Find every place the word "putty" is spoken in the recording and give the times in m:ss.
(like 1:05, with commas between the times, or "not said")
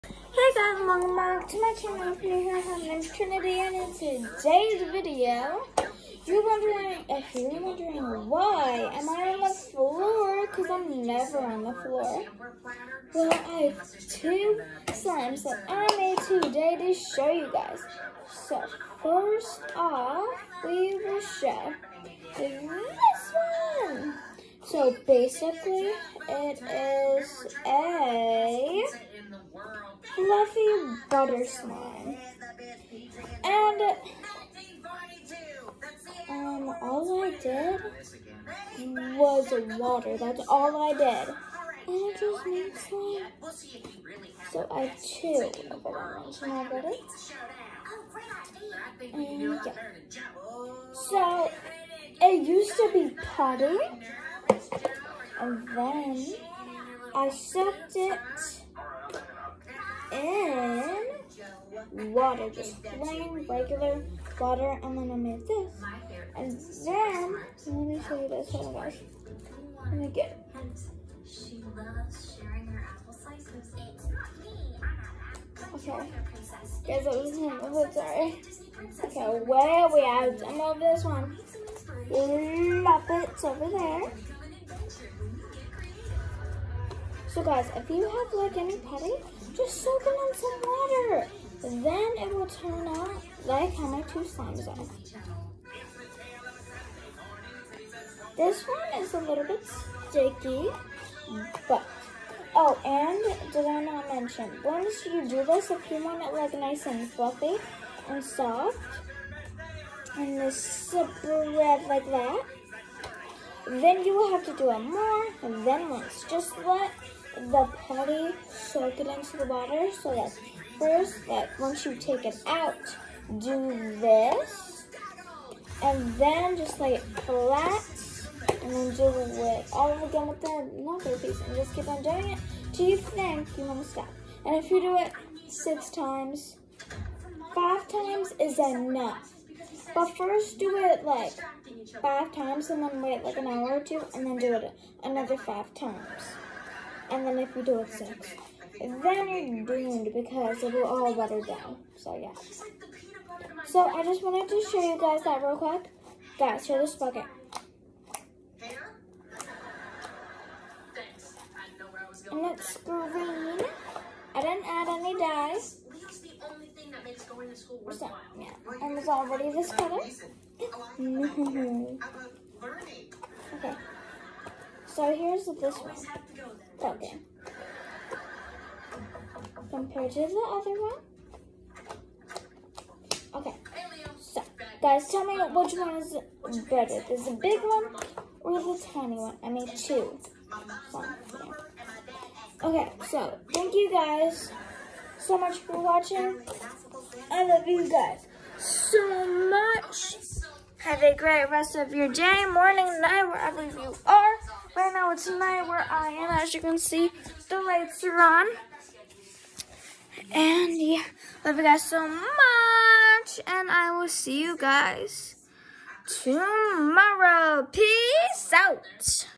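0:53, 1:28.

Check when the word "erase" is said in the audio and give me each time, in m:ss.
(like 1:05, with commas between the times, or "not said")
not said.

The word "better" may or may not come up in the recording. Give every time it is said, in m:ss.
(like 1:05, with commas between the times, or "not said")
3:06.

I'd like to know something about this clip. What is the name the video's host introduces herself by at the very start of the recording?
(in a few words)
Trinity.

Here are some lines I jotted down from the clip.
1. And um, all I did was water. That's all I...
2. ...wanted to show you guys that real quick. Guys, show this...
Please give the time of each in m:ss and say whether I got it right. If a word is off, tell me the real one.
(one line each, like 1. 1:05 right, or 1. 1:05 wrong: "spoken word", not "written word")
1. 0:33 right
2. 2:34 right.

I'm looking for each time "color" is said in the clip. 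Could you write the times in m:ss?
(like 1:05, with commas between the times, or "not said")
2:49.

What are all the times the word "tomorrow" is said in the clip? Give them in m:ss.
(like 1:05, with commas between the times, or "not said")
3:36.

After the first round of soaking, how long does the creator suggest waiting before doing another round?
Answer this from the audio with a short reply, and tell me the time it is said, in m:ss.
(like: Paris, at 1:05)
An hour or two, at 2:23.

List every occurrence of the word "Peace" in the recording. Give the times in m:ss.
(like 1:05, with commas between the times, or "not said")
3:37.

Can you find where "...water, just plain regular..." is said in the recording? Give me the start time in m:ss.
1:02.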